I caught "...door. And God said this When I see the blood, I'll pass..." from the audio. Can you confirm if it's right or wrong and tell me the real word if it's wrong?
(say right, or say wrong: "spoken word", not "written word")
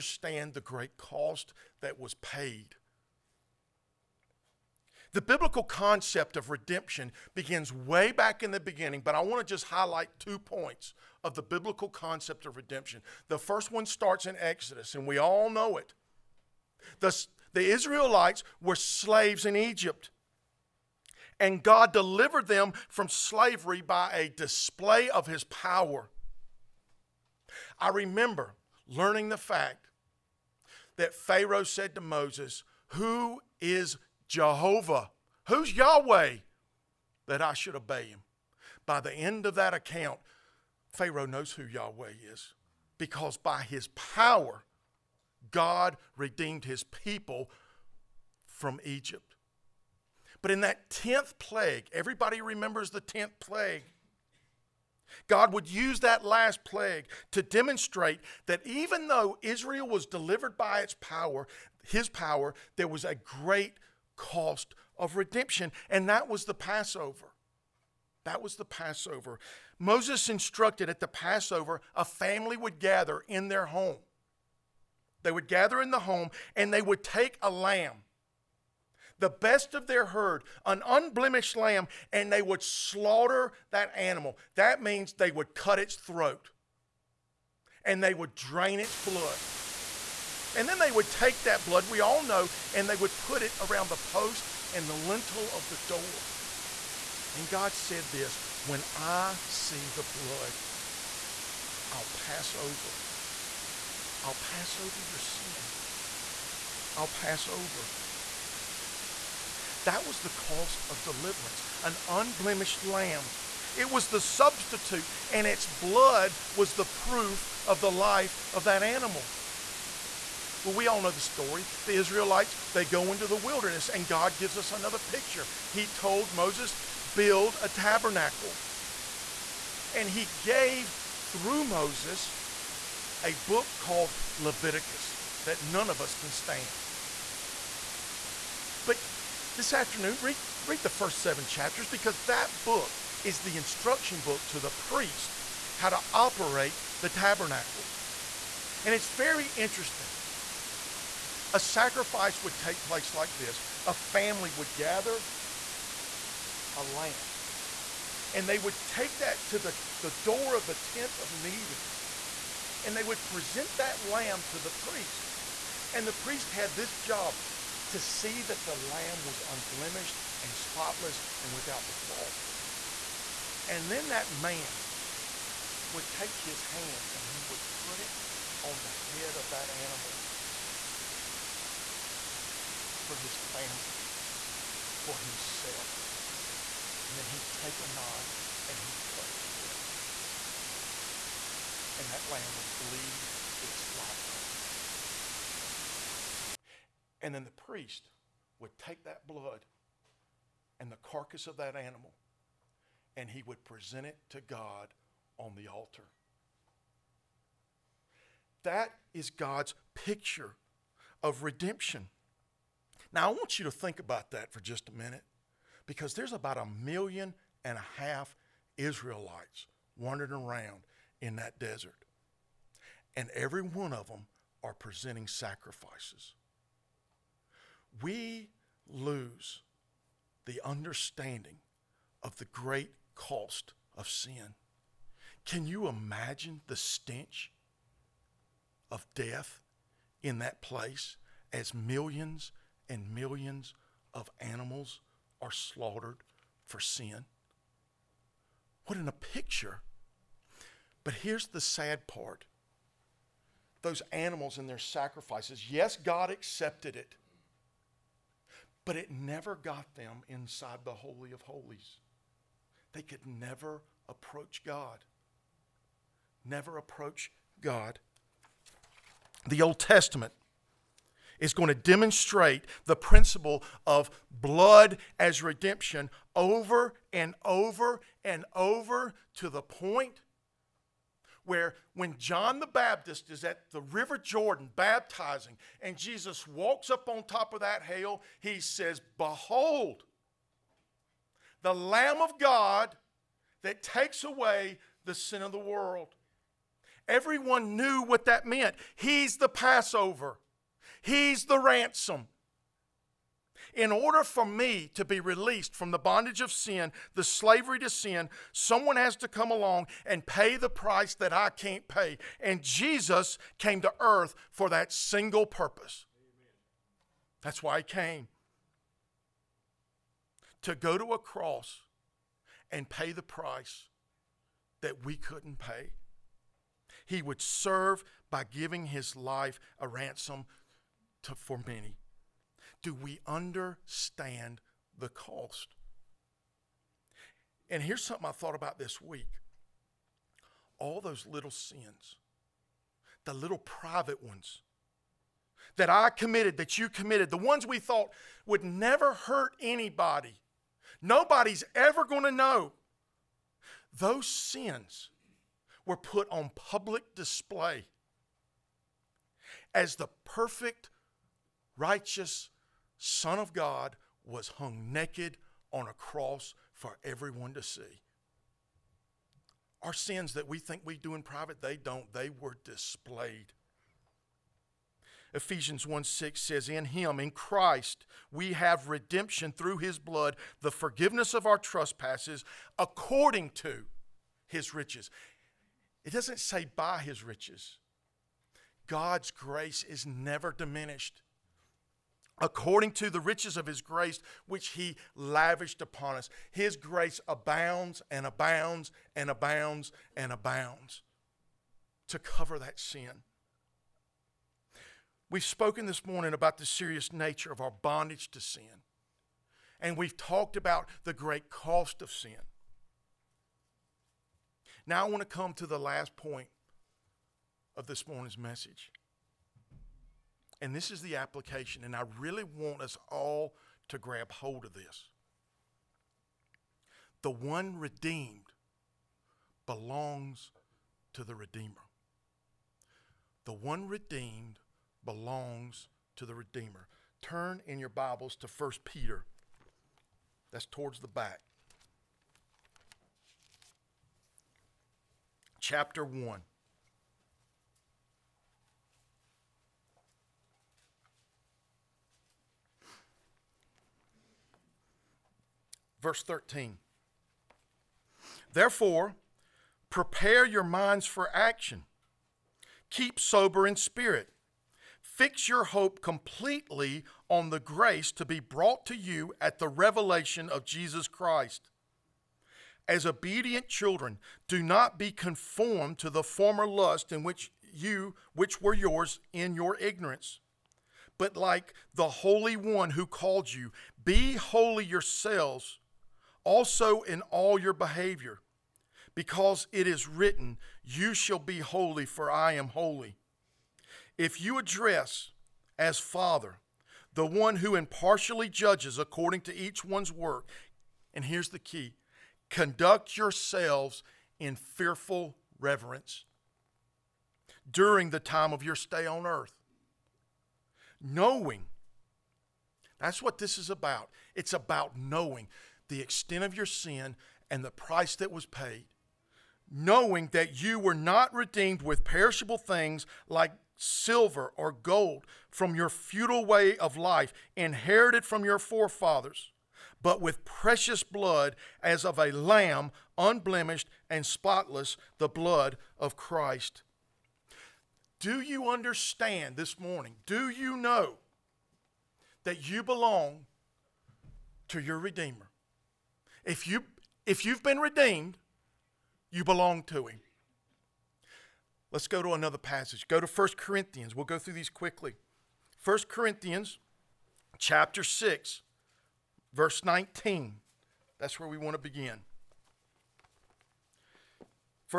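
right.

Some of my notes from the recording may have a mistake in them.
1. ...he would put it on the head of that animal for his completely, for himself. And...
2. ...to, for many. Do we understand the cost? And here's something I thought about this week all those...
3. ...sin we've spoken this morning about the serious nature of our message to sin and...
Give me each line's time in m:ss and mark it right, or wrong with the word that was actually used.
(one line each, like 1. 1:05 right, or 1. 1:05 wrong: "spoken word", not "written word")
1. 2:57 wrong: "family", not "completely"
2. 5:31 right
3. 6:42 wrong: "bondage", not "message".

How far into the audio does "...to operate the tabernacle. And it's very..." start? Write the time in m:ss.
2:25.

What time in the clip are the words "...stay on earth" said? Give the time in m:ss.
8:28.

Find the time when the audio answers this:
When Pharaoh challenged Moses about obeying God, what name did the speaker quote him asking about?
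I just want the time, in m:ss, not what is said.
0:34.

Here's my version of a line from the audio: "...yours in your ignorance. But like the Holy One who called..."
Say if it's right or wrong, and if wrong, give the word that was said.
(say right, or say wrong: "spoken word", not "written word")
right.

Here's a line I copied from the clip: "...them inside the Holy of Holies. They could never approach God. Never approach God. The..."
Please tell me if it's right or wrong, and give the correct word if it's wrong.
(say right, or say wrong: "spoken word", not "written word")
right.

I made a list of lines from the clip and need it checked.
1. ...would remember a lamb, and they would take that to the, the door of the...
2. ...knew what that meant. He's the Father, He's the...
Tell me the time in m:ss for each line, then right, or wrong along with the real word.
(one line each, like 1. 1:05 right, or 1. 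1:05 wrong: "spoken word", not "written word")
1. 2:34 wrong: "gather", not "remember"
2. 4:57 wrong: "Passover", not "Father".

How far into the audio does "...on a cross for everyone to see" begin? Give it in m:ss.
6:05.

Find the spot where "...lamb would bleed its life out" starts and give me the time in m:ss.
3:12.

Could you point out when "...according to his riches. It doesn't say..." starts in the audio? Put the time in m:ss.
6:22.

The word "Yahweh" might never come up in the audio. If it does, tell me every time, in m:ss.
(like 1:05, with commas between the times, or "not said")
0:35, 0:41.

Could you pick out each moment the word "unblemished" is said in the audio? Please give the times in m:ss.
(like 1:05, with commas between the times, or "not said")
1:20, 1:52, 2:49, 8:53.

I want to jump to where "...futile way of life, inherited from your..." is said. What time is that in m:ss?
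8:45.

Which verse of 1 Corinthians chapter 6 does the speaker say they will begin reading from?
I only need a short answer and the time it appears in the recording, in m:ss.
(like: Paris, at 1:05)
19, at 9:19.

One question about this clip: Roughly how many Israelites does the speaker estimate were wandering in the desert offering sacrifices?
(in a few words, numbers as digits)
1.5 million.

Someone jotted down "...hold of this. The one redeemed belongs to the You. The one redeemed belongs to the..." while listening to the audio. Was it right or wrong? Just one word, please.
wrong.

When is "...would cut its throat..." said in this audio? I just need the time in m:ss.
1:25.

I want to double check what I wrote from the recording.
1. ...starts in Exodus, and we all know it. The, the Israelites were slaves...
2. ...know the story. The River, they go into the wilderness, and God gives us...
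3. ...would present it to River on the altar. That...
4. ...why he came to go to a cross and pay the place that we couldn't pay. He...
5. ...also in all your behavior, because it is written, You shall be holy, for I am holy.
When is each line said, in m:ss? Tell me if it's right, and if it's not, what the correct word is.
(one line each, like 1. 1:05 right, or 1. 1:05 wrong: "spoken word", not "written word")
1. 0:13 right
2. 2:01 wrong: "Israelites", not "River"
3. 3:23 wrong: "God", not "River"
4. 5:17 wrong: "price", not "place"
5. 8:06 right.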